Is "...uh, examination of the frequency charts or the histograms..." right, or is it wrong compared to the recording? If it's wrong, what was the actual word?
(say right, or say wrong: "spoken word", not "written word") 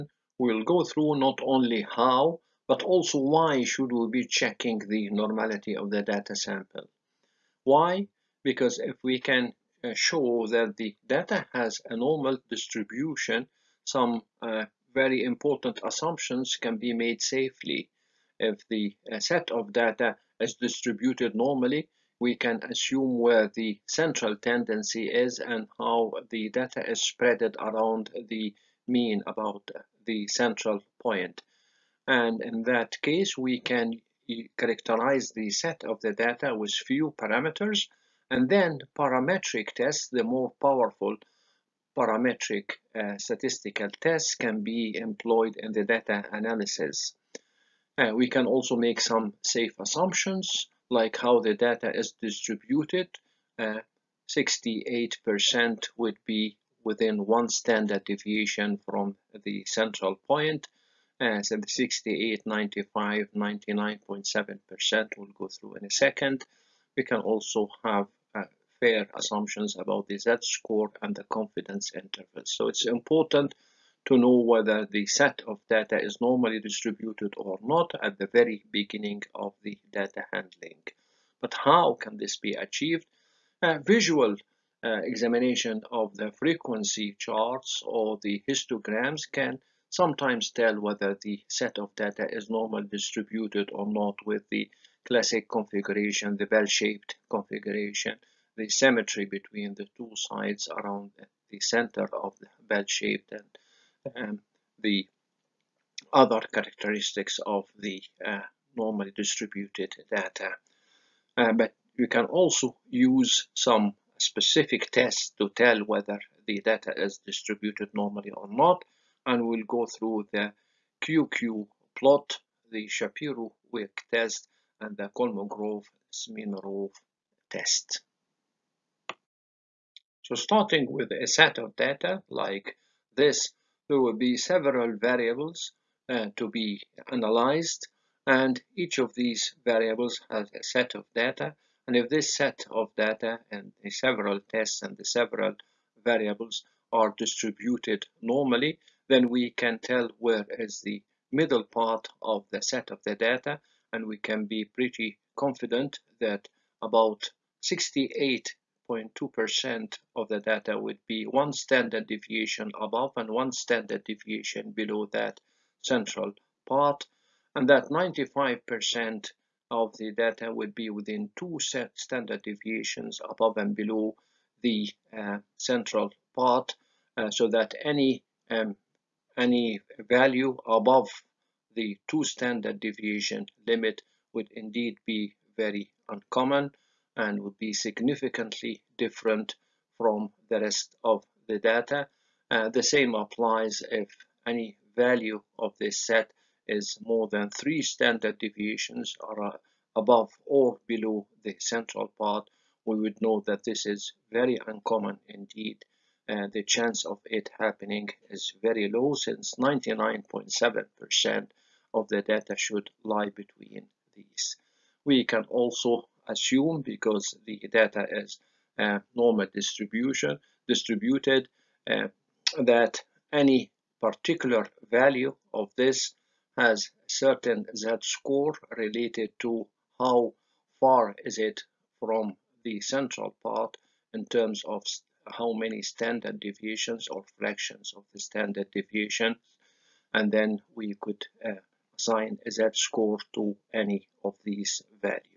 right.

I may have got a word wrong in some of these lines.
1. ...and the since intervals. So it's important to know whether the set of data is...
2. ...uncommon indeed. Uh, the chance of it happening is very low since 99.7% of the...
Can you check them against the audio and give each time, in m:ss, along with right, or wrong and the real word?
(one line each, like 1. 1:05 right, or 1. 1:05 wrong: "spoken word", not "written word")
1. 1:11 wrong: "confidence", not "since"
2. 3:24 right.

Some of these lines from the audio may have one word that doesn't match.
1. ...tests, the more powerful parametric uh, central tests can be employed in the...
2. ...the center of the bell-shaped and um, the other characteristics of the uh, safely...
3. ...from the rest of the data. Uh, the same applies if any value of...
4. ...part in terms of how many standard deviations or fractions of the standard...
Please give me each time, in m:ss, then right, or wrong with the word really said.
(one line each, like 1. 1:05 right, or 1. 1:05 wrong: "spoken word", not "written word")
1. 0:39 wrong: "statistical", not "central"
2. 1:41 wrong: "normally", not "safely"
3. 3:09 right
4. 3:53 right.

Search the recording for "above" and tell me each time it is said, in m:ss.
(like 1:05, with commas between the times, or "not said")
2:42, 2:53, 3:00, 3:19.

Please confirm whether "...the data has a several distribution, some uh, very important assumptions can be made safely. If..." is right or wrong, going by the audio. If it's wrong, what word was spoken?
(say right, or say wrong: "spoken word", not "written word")
wrong: "normal", not "several".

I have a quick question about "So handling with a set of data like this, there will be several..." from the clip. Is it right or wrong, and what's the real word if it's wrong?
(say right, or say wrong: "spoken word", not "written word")
wrong: "starting", not "handling".